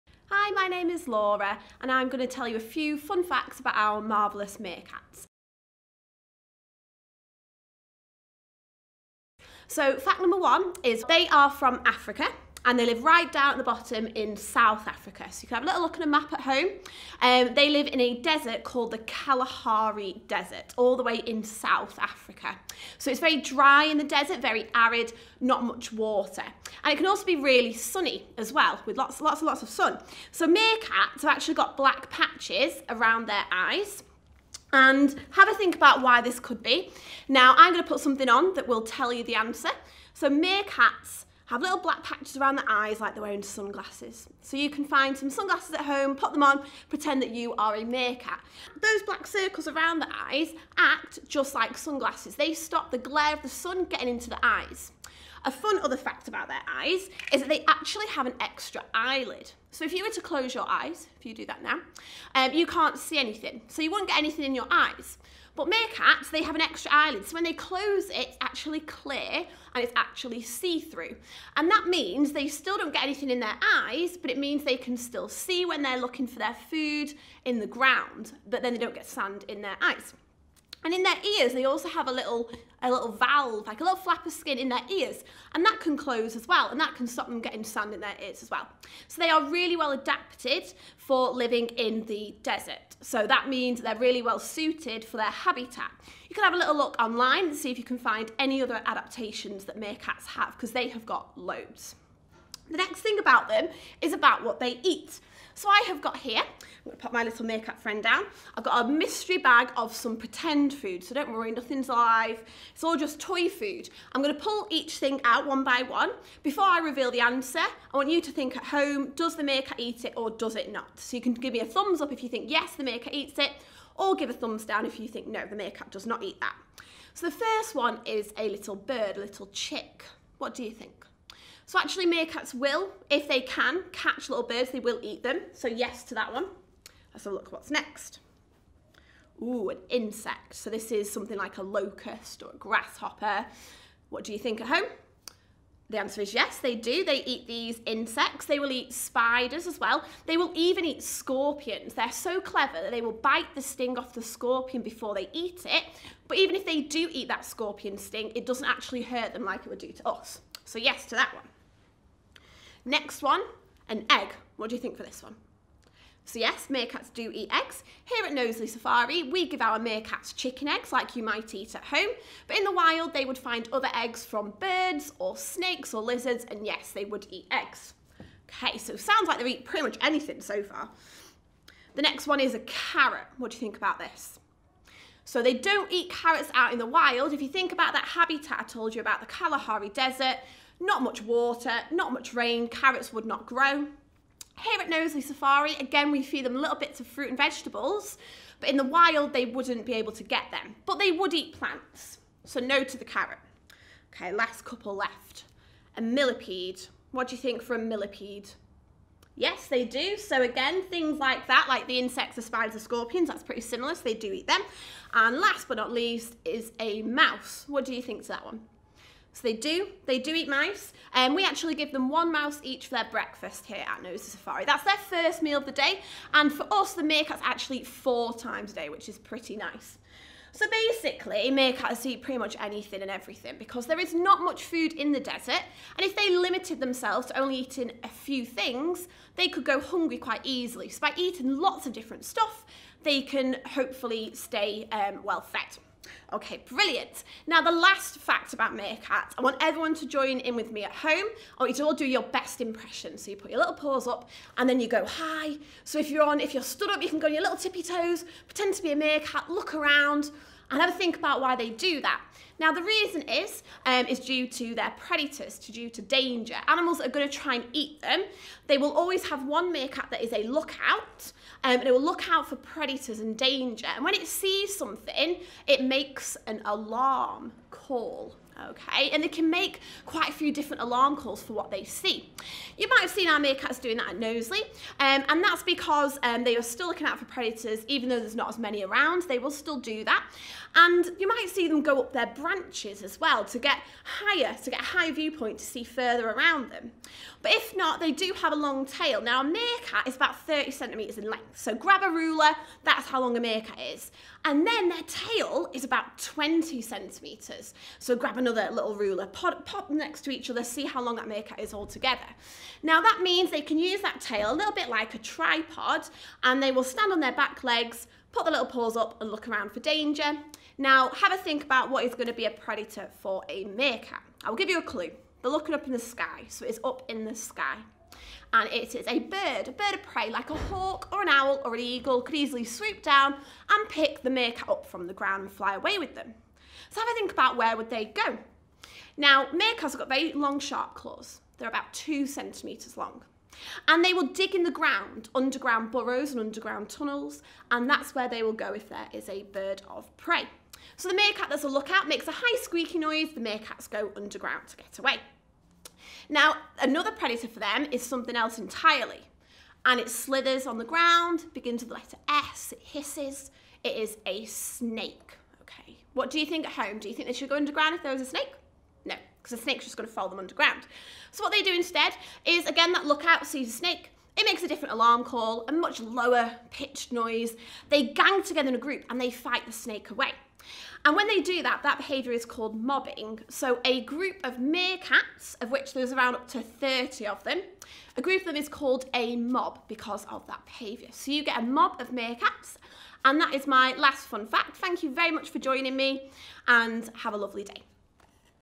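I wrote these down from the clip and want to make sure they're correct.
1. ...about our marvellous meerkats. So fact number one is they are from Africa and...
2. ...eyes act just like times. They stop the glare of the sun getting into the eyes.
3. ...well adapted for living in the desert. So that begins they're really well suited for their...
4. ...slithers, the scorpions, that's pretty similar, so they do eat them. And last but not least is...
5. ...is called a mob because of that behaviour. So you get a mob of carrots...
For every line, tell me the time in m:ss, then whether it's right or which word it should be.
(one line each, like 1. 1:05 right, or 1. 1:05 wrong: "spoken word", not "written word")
1. 0:03 right
2. 0:50 wrong: "sunglasses", not "times"
3. 1:29 wrong: "means", not "begins"
4. 3:32 wrong: "spiders", not "slithers"
5. 6:28 wrong: "meerkats", not "carrots".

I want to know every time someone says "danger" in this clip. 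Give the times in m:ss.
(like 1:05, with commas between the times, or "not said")
4:26, 4:33, 5:19.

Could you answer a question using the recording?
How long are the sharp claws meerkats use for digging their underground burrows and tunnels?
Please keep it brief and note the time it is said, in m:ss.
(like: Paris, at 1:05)
2 centimetres, at 5:41.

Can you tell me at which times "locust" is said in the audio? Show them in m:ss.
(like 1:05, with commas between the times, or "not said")
2:21.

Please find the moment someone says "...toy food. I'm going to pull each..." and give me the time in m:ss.
1:53.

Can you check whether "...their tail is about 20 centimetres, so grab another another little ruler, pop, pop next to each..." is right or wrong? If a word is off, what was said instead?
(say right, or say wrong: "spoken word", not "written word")
right.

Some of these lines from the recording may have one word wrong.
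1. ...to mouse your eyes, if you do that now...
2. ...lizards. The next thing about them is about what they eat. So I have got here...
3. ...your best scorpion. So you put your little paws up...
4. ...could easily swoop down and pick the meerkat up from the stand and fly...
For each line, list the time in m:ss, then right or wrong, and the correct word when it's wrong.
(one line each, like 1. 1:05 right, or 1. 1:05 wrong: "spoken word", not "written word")
1. 1:00 wrong: "close", not "mouse"
2. 1:41 wrong: "loads", not "lizards"
3. 4:12 wrong: "impression", not "scorpion"
4. 5:32 wrong: "ground", not "stand".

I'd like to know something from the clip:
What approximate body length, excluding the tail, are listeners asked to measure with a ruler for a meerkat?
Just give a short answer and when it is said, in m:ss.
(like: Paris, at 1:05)
30 centimetres, at 5:00.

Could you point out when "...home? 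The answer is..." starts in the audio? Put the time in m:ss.
2:24.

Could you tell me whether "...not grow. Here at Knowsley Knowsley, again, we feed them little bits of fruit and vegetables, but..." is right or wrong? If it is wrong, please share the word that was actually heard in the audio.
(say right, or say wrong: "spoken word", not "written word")
wrong: "Safari", not "Knowsley".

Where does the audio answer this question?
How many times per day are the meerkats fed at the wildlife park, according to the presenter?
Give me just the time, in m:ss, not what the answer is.
3:47.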